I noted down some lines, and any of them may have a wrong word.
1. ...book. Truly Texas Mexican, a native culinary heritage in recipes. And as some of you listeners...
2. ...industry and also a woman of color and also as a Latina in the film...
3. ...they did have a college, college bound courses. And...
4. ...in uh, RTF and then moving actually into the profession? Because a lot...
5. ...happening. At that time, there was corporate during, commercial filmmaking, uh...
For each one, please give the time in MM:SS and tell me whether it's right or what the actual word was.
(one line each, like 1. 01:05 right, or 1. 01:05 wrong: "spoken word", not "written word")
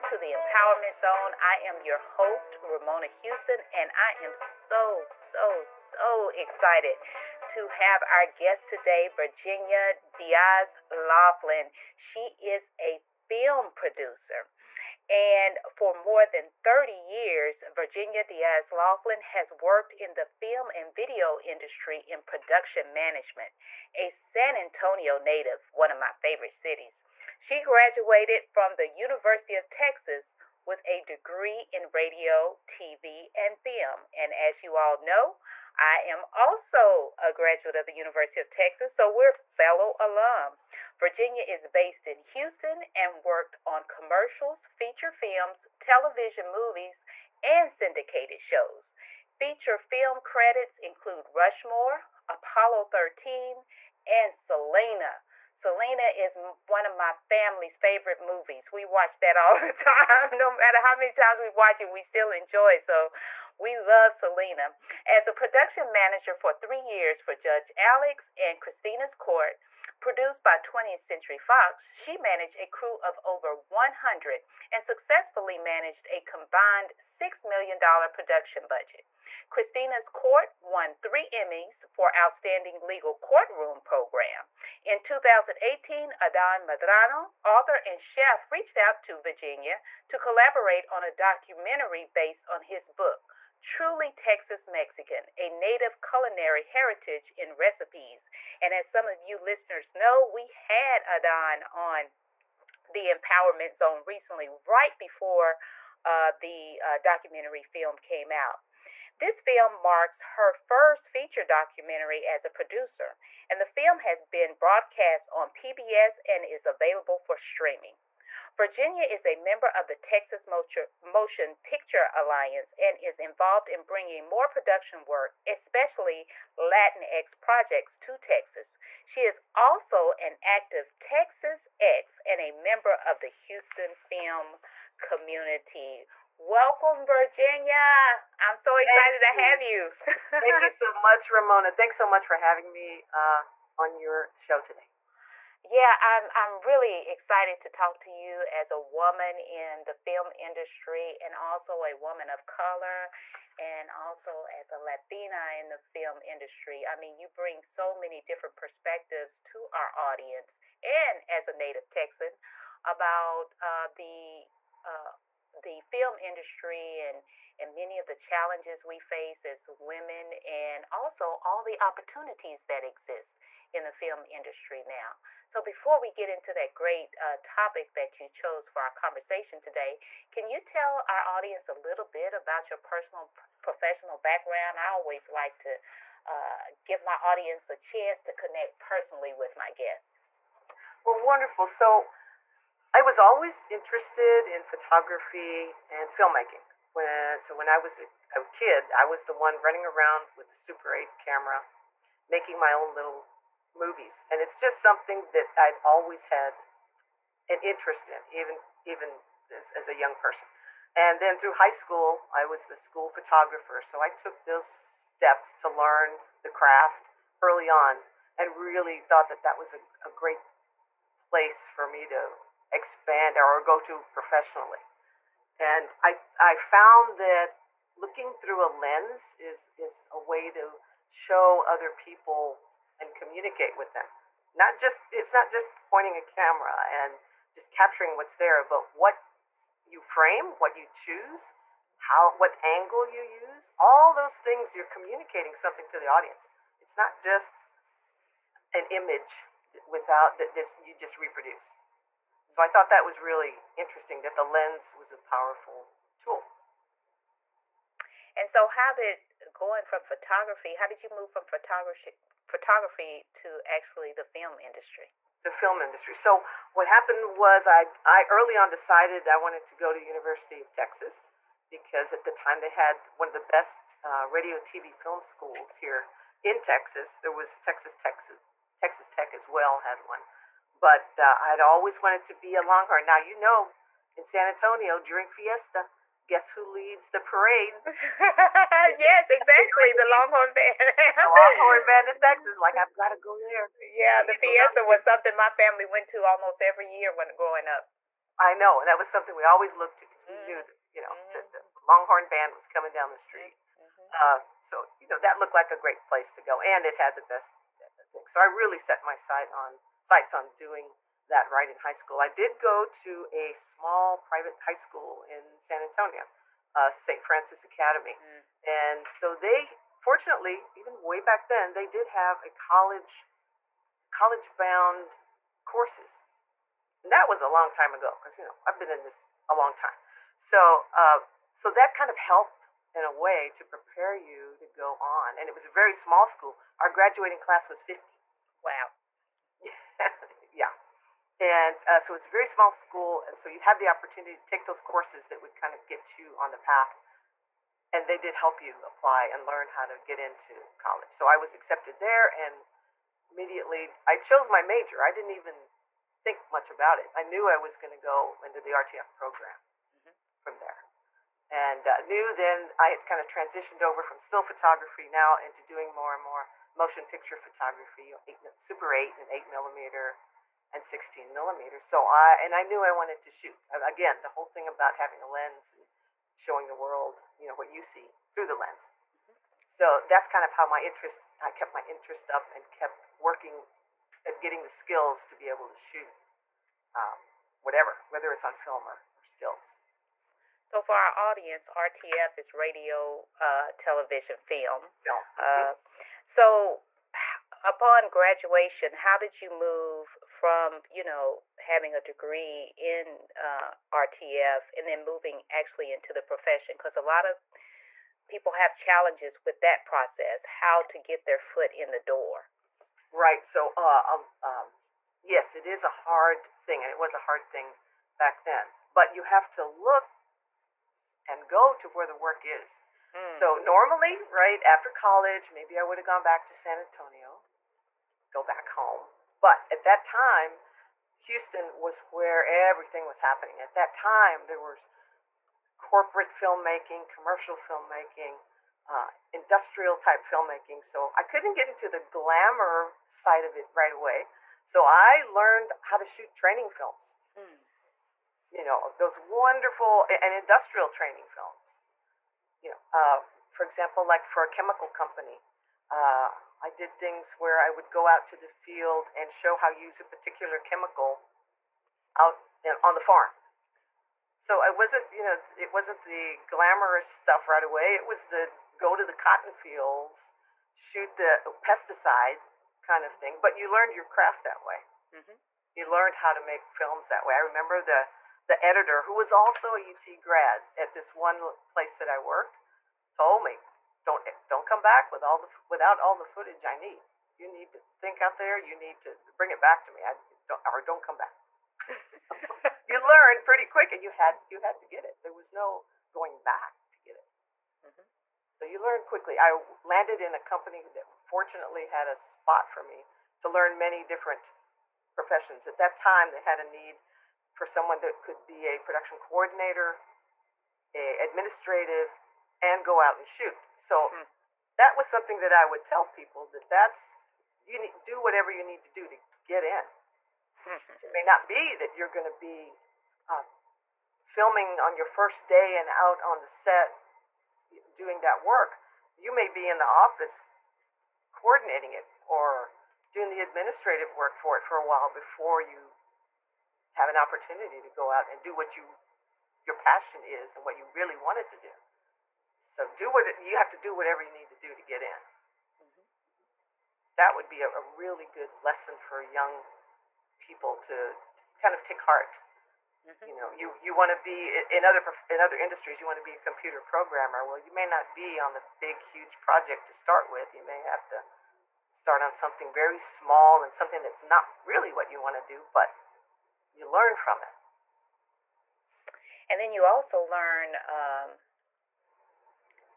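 1. 01:32 right
2. 02:30 right
3. 05:21 right
4. 06:42 right
5. 07:13 wrong: "filmmaking", not "during".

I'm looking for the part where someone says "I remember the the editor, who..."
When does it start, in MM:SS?
07:57.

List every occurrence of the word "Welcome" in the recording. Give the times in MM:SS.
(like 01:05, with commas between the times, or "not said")
02:16.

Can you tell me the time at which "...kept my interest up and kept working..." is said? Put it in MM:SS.
06:21.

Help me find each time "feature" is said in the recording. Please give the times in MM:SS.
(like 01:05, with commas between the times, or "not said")
00:44, 00:49, 01:51.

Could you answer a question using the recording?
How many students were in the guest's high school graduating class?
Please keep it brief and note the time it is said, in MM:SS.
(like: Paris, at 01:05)
50, at 05:37.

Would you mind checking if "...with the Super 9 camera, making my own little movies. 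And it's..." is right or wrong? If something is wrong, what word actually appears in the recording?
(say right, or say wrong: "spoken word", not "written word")
wrong: "8", not "9".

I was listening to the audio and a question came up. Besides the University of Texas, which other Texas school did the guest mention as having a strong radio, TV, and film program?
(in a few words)
Texas Tech.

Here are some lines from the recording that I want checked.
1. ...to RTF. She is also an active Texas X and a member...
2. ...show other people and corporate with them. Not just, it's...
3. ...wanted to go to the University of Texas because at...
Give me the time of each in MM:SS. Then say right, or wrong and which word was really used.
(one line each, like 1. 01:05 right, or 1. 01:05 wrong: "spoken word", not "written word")
1. 02:07 wrong: "Texas", not "RTF"
2. 03:51 wrong: "communicate", not "corporate"
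3. 04:29 right.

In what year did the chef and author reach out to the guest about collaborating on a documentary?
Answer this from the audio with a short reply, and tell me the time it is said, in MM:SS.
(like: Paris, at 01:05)
2018, at 01:25.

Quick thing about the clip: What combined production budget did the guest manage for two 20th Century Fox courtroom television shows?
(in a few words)
$6 million.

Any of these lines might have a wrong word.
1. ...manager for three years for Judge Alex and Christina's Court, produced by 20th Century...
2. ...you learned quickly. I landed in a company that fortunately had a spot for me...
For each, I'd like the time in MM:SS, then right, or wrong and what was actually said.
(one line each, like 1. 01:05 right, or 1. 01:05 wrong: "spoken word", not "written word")
1. 01:05 right
2. 08:18 right.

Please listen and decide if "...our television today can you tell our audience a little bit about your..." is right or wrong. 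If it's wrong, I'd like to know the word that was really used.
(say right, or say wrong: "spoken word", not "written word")
wrong: "conversation", not "television".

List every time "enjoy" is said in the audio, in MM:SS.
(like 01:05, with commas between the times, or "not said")
01:02.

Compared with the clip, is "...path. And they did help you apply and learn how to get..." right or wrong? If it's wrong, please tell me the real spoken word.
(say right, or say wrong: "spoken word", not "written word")
right.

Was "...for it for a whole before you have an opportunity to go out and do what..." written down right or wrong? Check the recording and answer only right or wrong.
wrong.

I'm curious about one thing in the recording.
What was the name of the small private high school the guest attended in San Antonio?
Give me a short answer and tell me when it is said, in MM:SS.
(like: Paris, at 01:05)
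St. Francis Academy, at 05:16.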